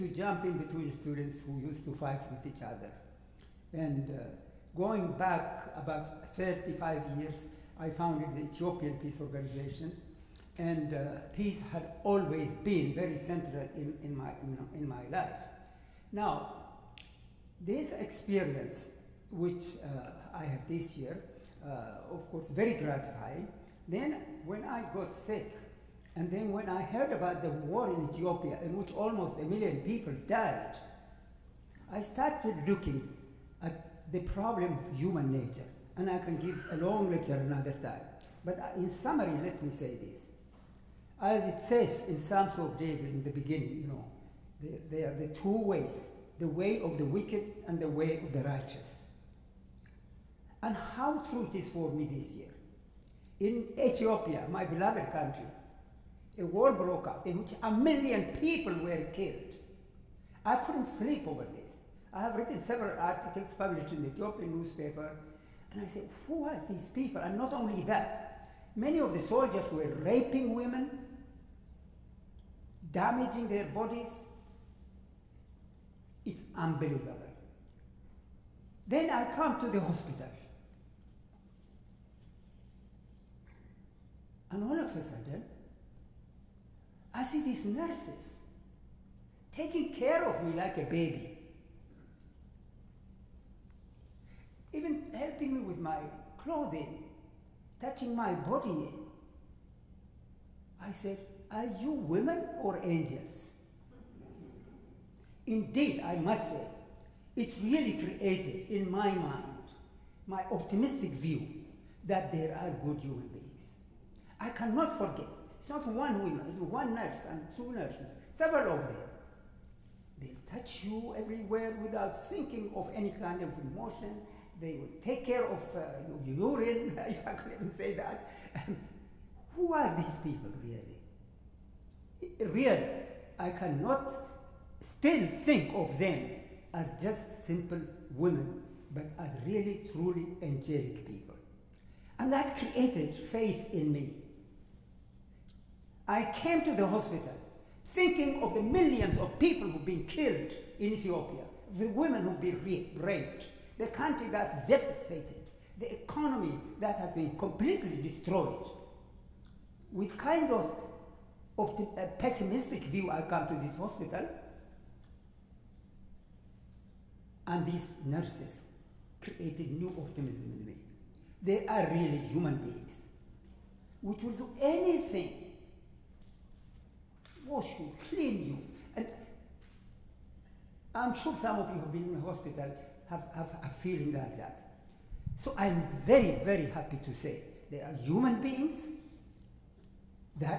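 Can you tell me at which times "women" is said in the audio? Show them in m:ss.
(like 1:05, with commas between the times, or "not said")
1:10, 1:41, 2:18, 2:31.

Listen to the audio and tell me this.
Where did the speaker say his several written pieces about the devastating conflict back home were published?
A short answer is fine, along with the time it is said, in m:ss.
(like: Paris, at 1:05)
Ethiopian newspaper, at 1:04.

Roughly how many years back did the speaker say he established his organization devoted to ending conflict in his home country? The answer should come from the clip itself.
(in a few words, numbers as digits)
35 years.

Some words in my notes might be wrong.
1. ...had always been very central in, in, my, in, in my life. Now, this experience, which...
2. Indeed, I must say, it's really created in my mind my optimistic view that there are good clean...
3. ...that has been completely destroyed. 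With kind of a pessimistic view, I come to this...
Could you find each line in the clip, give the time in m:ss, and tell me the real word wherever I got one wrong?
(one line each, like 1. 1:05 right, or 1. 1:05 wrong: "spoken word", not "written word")
1. 0:11 right
2. 1:45 wrong: "human", not "clean"
3. 2:36 right.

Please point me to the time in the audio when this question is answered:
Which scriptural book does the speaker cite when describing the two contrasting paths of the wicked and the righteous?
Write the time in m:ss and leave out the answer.
0:42.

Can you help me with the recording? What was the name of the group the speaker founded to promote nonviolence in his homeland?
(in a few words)
Ethiopian Peace Organization.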